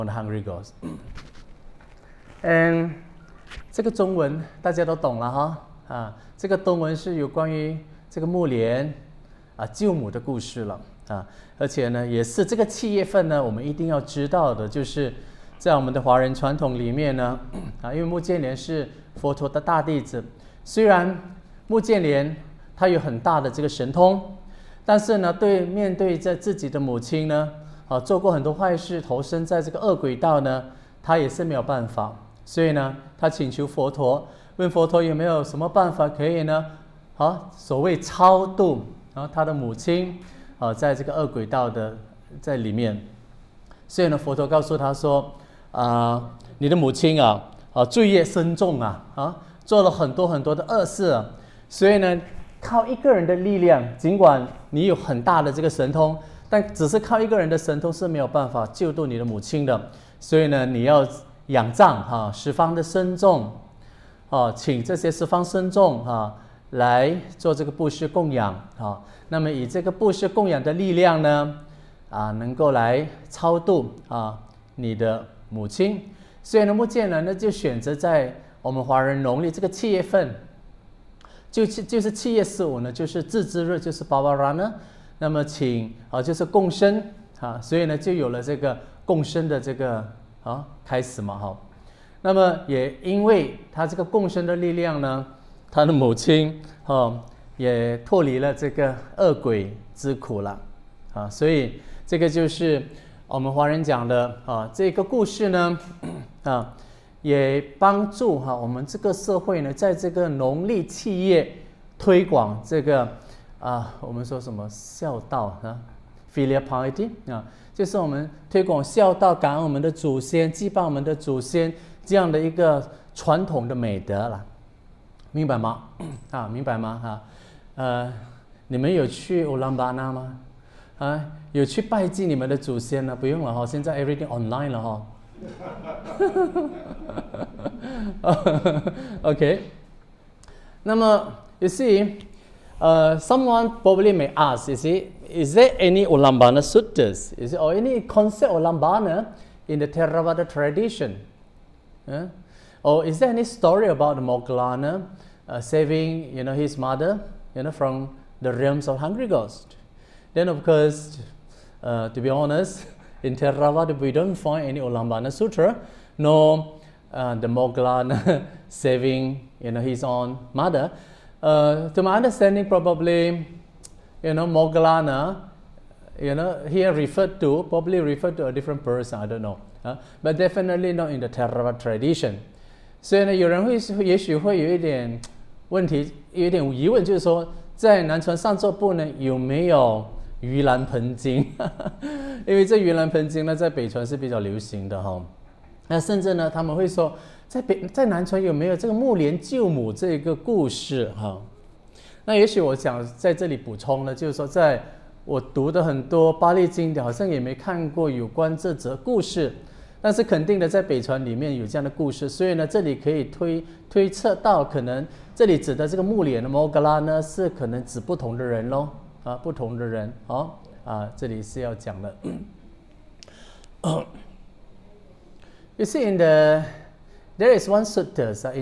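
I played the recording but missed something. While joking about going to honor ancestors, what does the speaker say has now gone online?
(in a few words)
everything.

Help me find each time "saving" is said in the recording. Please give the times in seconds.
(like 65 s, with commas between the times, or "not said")
155 s, 168 s.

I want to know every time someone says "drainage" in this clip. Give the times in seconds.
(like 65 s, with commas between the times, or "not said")
not said.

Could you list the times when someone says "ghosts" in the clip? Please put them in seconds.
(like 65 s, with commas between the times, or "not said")
0 s, 159 s.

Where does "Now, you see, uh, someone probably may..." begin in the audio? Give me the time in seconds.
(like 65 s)
140 s.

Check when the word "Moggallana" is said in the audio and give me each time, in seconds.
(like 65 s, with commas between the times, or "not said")
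154 s, 174 s.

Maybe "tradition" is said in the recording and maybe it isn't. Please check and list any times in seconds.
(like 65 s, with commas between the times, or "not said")
150 s, 181 s.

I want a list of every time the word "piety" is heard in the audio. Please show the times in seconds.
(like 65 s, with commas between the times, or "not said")
116 s.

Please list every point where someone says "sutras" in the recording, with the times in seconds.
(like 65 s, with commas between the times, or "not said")
146 s, 165 s, 227 s.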